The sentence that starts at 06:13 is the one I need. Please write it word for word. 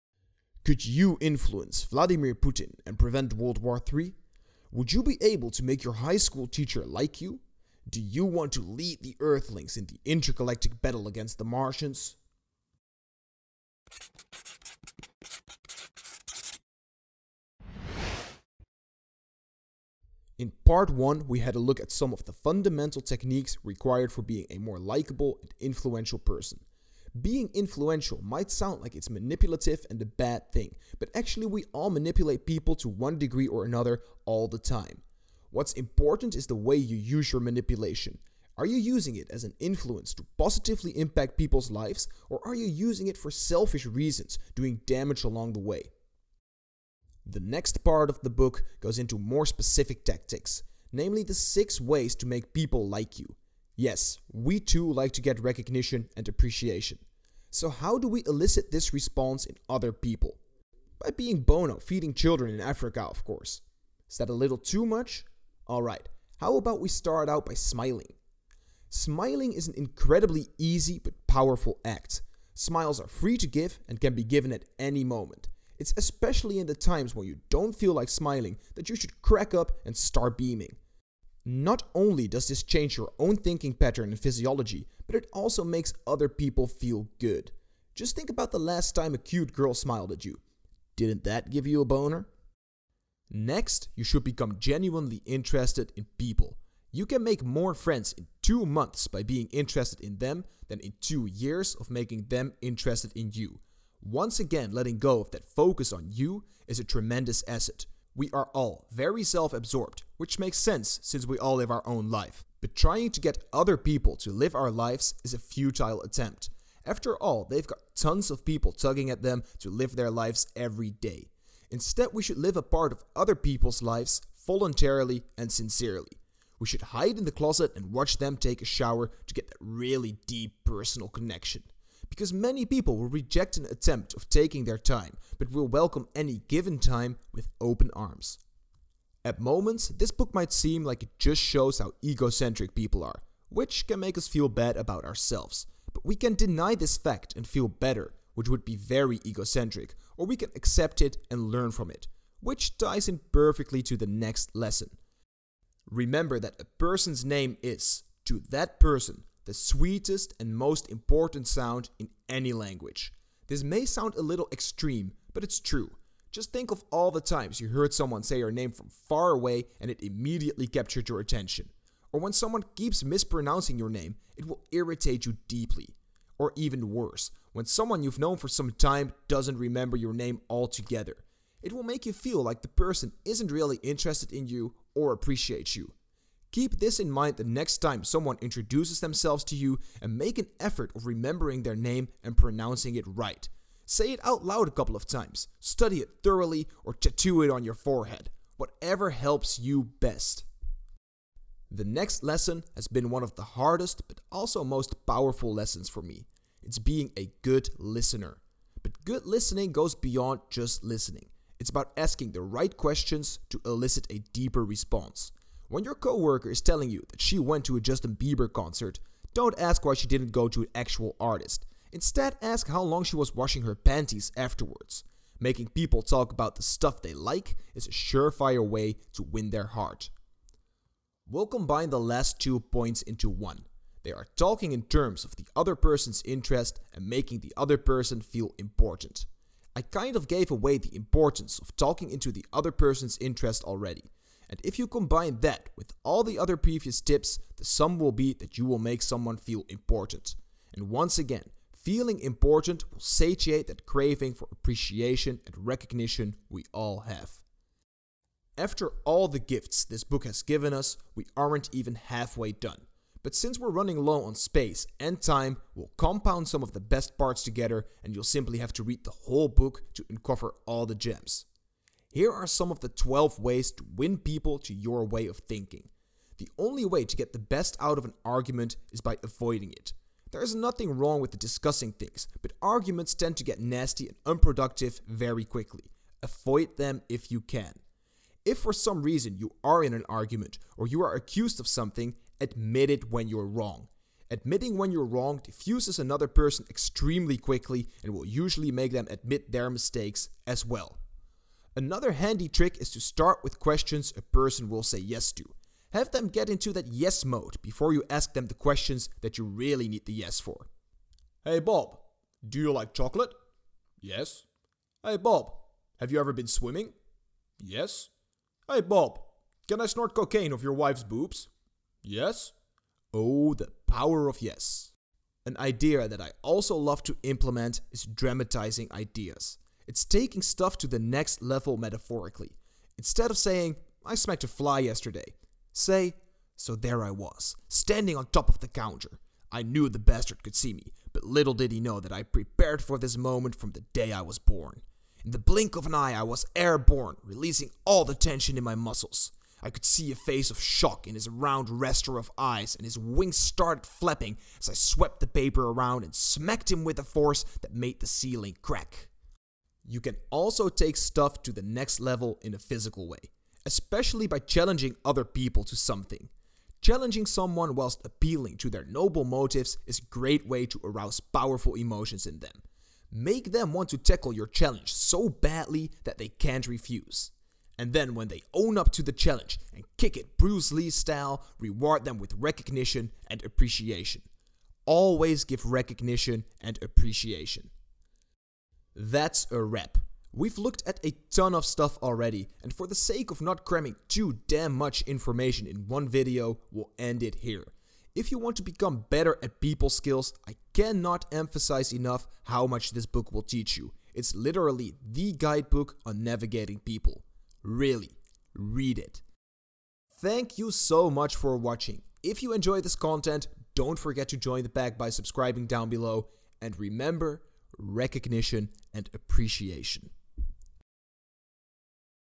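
Make them want to tackle your challenge so badly that they can't refuse.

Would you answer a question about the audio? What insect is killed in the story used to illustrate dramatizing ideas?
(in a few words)
fly.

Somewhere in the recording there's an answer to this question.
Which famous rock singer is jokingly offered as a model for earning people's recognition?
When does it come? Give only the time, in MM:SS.
01:01.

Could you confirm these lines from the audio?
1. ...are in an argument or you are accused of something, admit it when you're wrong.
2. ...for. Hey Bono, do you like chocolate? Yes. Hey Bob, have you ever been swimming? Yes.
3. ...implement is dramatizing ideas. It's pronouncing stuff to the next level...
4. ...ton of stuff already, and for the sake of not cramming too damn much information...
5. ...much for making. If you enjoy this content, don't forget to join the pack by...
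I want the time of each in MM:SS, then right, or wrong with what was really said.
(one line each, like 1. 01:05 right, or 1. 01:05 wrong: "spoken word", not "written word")
1. 04:49 right
2. 05:10 wrong: "Bob", not "Bono"
3. 05:27 wrong: "taking", not "pronouncing"
4. 06:31 right
5. 06:51 wrong: "watching", not "making".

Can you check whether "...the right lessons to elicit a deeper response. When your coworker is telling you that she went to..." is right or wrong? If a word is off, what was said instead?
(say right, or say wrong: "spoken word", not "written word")
wrong: "questions", not "lessons".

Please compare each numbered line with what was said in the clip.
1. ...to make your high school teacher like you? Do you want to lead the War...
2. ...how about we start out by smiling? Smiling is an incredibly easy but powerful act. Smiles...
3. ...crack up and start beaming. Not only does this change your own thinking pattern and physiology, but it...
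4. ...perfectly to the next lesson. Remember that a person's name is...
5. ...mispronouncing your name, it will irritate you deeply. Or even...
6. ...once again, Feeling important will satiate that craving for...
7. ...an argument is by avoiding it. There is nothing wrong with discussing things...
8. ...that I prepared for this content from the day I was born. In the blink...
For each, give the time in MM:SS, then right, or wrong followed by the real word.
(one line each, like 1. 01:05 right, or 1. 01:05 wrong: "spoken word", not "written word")
1. 00:05 wrong: "Earthlings", not "War"
2. 01:06 right
3. 01:19 right
4. 02:33 right
5. 02:53 right
6. 04:10 right
7. 04:38 right
8. 05:41 wrong: "moment", not "content".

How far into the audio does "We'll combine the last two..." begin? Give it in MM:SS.
03:51.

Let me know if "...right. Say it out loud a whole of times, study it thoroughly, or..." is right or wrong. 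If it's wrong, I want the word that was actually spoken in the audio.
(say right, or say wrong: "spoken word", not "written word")
wrong: "couple", not "whole".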